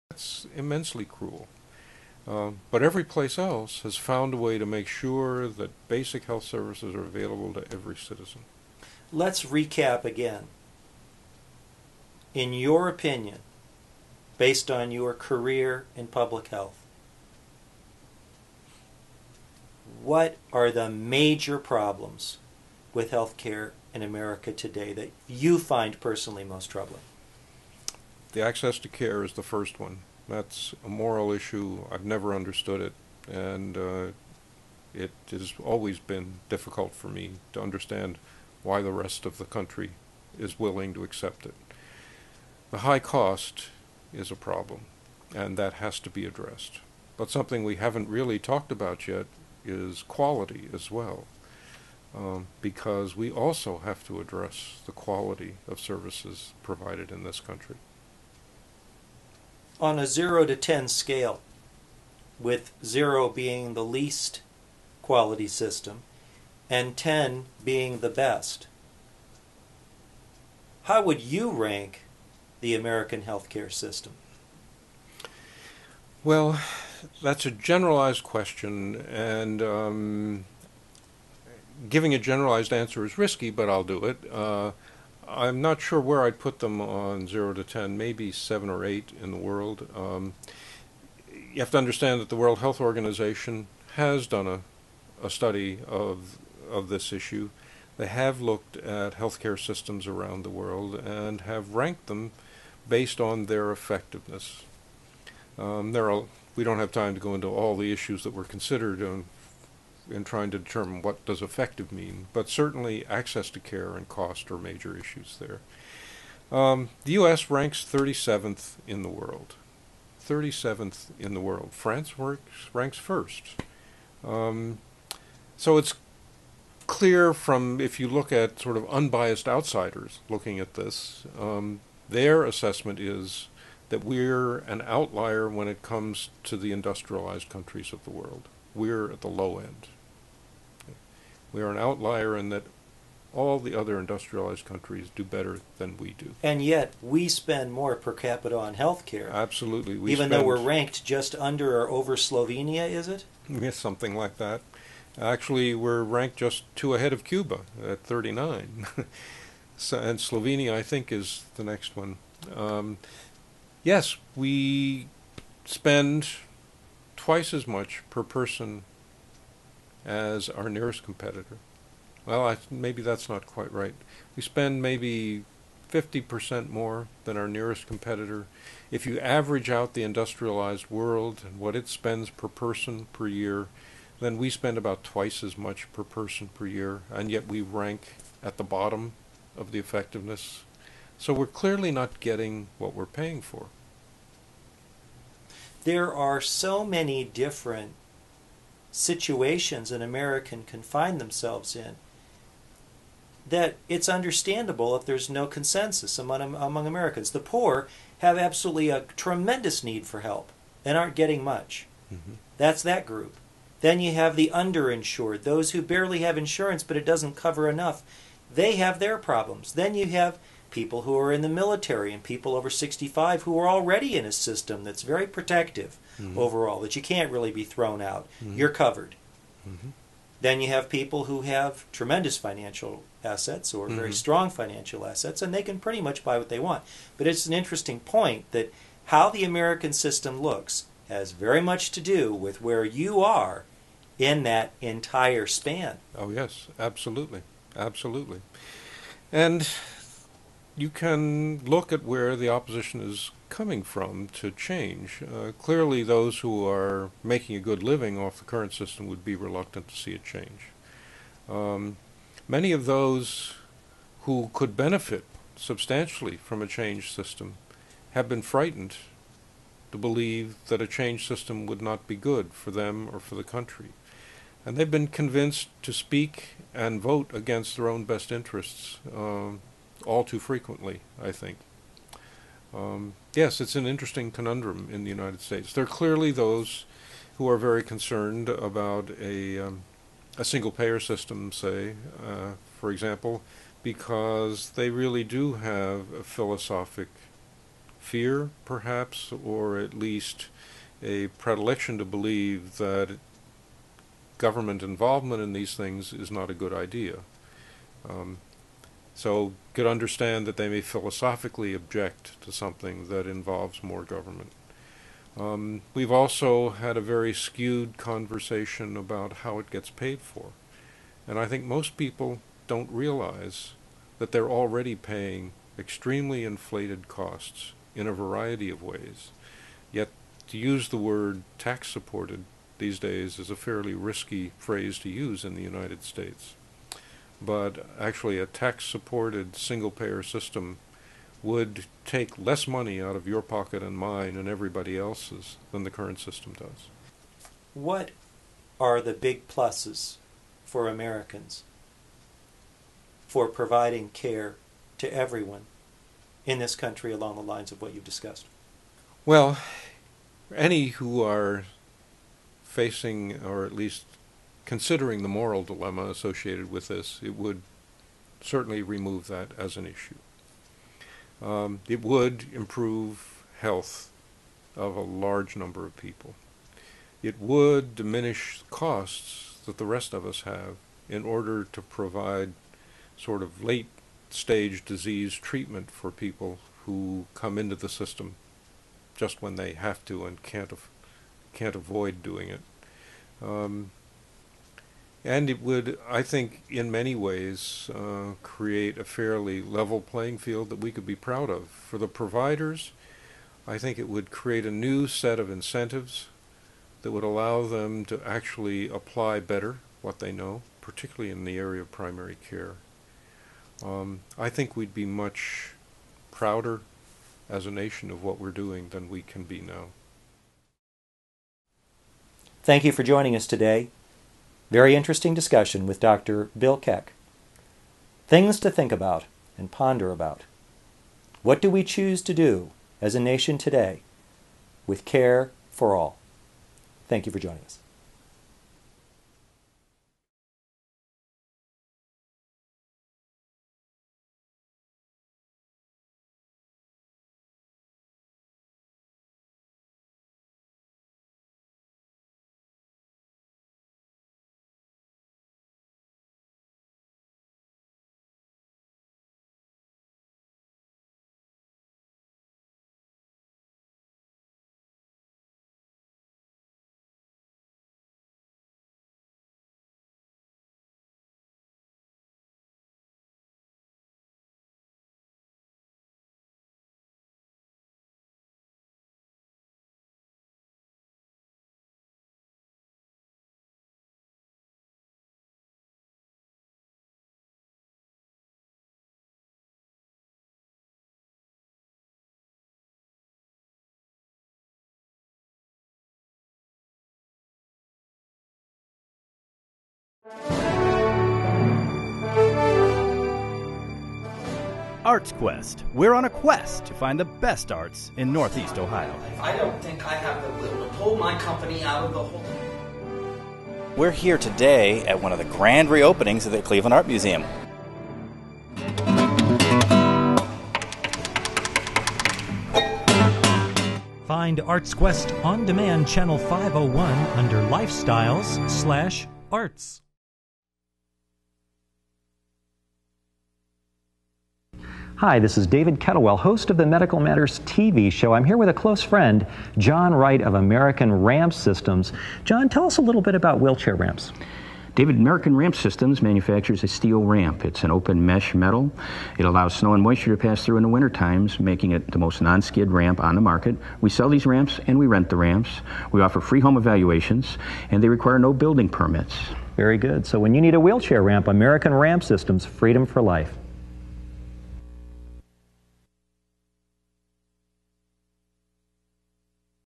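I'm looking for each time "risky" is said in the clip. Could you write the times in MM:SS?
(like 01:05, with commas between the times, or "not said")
01:23, 05:33.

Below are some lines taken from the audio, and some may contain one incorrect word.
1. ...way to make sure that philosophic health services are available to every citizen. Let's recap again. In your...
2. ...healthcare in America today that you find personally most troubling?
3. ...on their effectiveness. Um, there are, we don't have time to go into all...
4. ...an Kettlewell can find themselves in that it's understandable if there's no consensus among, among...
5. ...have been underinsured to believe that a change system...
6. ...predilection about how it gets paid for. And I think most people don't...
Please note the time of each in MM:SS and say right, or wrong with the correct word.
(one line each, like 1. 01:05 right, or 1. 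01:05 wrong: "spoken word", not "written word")
1. 00:04 wrong: "basic", not "philosophic"
2. 00:23 right
3. 01:43 right
4. 03:19 wrong: "American", not "Kettlewell"
5. 04:28 wrong: "frightened", not "underinsured"
6. 05:17 wrong: "conversation", not "predilection".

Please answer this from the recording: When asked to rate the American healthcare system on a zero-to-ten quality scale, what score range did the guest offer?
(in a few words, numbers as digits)
7 or 8.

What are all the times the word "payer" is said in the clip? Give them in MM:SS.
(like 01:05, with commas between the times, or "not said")
04:50, 05:39.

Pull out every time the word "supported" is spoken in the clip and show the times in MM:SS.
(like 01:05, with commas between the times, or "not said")
05:31, 05:38.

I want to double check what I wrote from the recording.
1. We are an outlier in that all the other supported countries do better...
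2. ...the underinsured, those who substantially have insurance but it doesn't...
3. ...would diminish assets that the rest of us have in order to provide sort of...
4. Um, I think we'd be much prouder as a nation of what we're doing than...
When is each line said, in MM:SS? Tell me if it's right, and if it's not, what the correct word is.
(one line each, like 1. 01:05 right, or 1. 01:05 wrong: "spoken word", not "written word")
1. 02:21 wrong: "industrialized", not "supported"
2. 03:34 wrong: "barely", not "substantially"
3. 06:17 wrong: "costs", not "assets"
4. 06:53 right.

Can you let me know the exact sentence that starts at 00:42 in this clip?
The high cost is a problem, and that has to be addressed.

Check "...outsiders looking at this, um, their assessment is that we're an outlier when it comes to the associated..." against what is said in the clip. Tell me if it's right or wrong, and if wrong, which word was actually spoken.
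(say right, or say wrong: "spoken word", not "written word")
wrong: "industrialized", not "associated".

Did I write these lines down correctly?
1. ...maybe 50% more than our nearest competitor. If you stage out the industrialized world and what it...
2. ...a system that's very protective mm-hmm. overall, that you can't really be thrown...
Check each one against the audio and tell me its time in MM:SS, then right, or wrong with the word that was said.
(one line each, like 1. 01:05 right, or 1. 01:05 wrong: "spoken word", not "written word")
1. 02:54 wrong: "average", not "stage"
2. 03:44 right.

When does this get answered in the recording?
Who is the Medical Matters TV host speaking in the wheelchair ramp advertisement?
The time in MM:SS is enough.
08:55.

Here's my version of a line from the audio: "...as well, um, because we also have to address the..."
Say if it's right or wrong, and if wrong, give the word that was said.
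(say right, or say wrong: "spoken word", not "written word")
right.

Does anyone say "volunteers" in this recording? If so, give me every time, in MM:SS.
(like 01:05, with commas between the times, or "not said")
not said.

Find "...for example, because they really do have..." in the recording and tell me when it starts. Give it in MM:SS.
04:52.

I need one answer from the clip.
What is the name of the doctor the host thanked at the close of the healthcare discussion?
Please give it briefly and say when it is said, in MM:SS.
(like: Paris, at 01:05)
Bill Keck, at 07:06.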